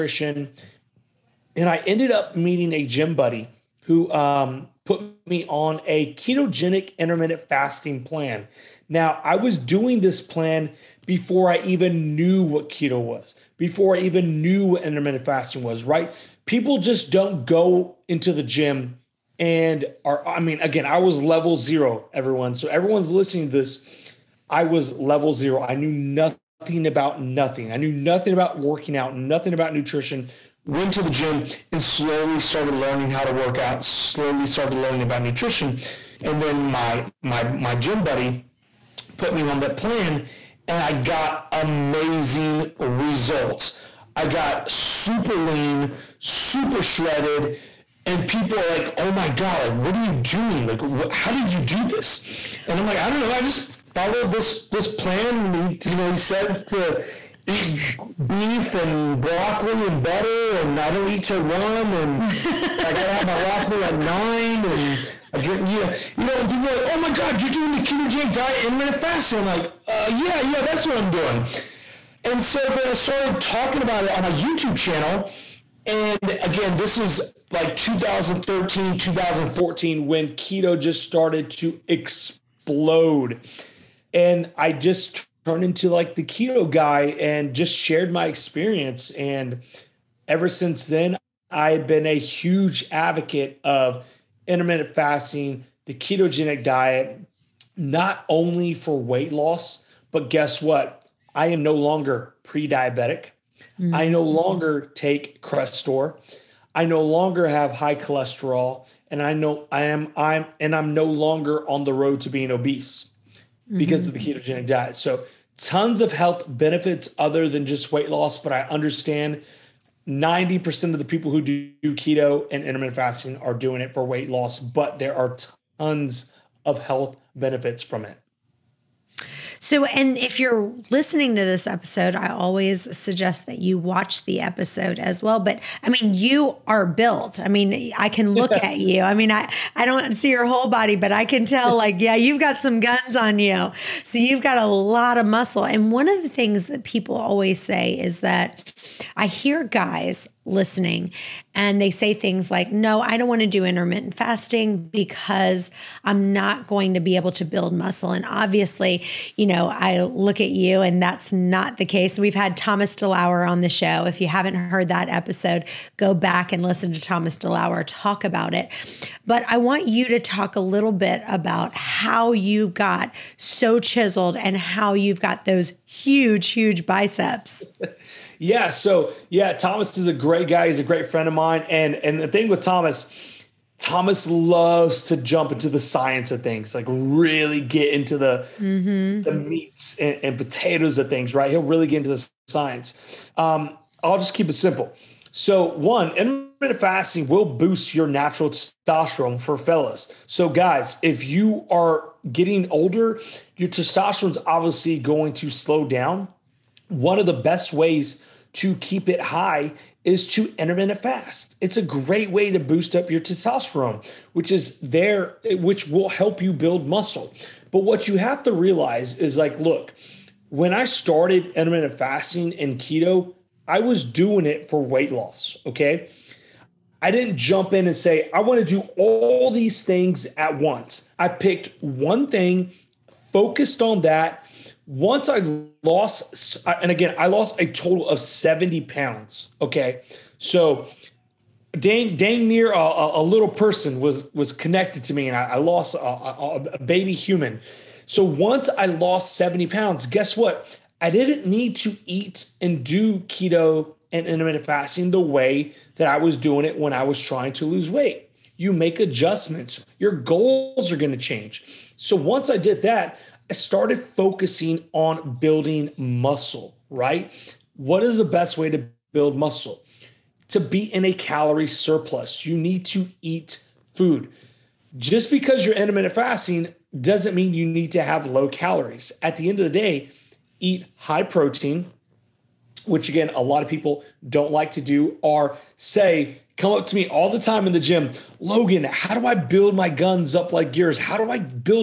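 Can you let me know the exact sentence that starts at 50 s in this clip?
Like wh- how did you do this?" And I'm like, "I don't know.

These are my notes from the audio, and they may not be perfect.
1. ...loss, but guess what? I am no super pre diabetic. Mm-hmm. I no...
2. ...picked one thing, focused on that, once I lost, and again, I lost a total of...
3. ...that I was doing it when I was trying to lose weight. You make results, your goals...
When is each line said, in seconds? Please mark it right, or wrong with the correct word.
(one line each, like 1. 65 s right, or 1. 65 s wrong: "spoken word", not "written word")
1. 99 s wrong: "longer", not "super"
2. 231 s right
3. 255 s wrong: "adjustments", not "results".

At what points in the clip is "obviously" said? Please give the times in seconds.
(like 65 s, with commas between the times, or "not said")
158 s, 204 s.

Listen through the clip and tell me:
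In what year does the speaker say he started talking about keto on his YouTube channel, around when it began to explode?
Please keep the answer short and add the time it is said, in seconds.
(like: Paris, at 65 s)
2013, at 77 s.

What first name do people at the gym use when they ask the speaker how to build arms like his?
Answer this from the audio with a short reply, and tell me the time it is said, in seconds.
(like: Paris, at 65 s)
Logan, at 288 s.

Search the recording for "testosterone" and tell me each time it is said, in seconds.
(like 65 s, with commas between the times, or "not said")
198 s, 203 s, 213 s.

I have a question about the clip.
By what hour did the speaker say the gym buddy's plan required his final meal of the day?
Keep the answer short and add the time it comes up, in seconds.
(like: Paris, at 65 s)
9, at 63 s.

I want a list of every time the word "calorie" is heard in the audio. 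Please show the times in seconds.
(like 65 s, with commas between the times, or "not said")
271 s, 278 s.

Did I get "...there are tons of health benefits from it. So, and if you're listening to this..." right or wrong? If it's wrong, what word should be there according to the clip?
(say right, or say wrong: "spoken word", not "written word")
right.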